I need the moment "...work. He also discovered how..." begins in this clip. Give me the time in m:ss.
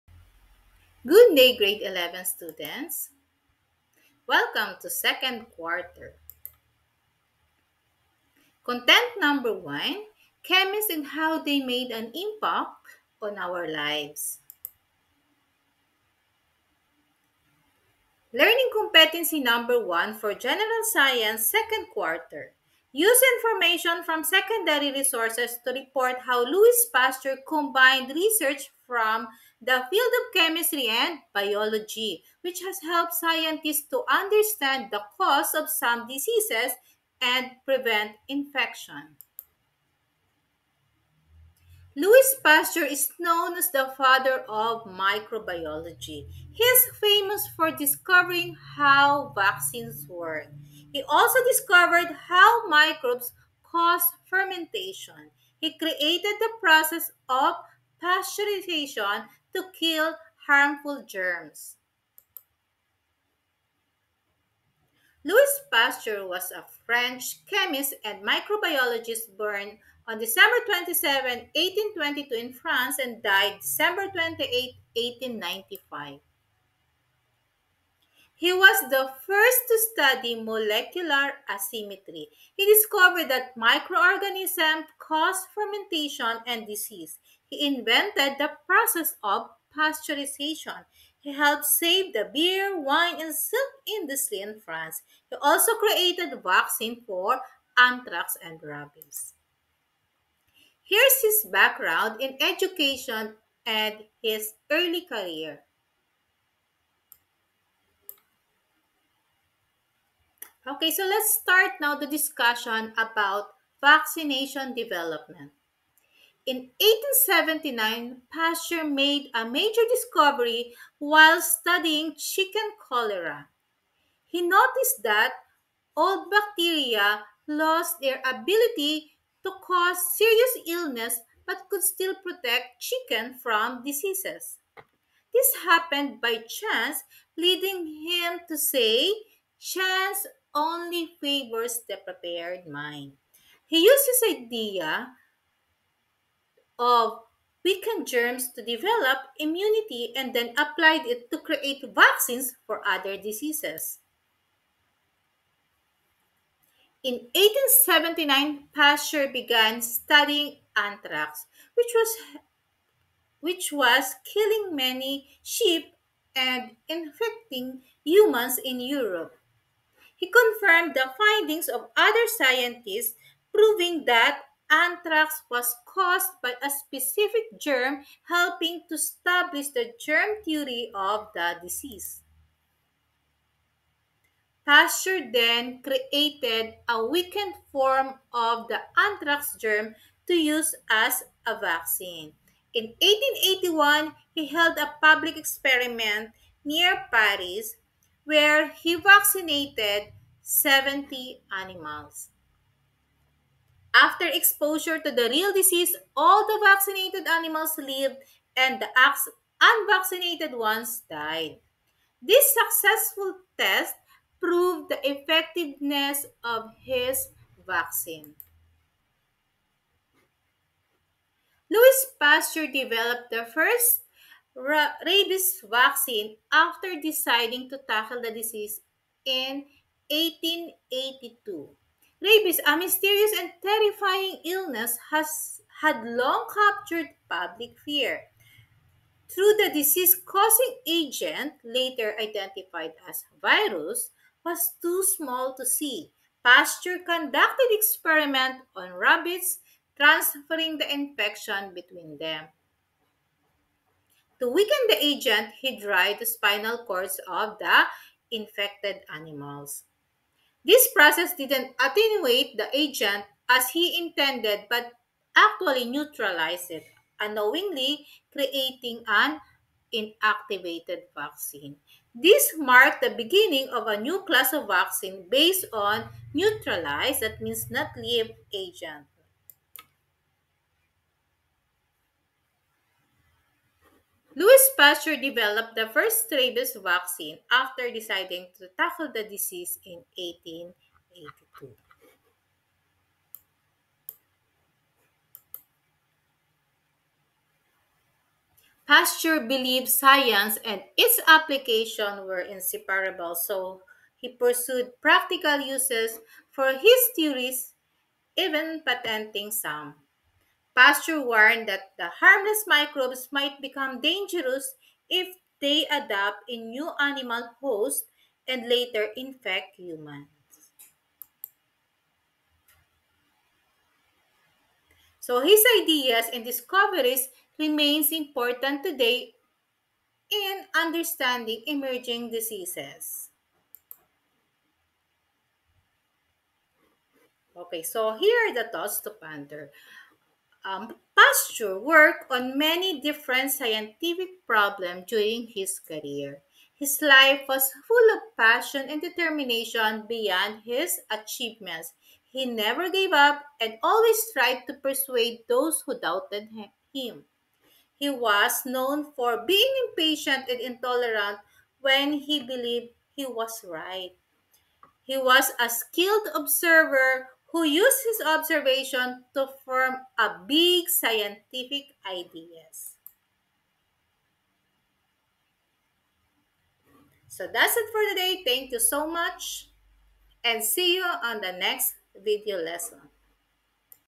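0:50.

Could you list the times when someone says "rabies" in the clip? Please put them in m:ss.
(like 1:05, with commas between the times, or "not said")
1:38, 3:44, 3:52, 4:46.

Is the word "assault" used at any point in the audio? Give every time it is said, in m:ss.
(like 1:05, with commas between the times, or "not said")
not said.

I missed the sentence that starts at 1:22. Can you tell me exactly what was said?
He discovered that microorganisms cause fermentation and disease.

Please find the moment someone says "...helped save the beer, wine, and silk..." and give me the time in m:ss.
1:31.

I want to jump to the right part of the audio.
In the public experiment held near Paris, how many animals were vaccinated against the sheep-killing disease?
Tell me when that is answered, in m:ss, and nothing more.
3:20.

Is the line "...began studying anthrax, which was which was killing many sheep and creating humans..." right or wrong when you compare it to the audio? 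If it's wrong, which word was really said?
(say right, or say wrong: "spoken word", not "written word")
wrong: "infecting", not "creating".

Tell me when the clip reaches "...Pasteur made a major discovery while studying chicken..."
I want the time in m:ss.
1:58.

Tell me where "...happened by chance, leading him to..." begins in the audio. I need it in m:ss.
2:15.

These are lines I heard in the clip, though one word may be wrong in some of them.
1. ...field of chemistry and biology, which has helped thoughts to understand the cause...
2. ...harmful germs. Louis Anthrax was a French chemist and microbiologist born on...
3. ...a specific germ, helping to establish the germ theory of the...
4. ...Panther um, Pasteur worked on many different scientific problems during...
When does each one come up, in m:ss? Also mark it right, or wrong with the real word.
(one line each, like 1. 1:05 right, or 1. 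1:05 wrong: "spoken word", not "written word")
1. 0:29 wrong: "scientists", not "thoughts"
2. 1:00 wrong: "Pasteur", not "Anthrax"
3. 2:56 right
4. 5:39 right.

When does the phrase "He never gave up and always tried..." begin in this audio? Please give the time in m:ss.
5:52.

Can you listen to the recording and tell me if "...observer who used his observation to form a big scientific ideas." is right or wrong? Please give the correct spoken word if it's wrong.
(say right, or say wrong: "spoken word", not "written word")
right.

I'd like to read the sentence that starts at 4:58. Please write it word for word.
Pasteur believed science and its application were inseparable, so he pursued practical uses for his theories, even patenting some.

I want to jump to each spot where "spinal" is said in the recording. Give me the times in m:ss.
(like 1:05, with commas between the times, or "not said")
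4:16.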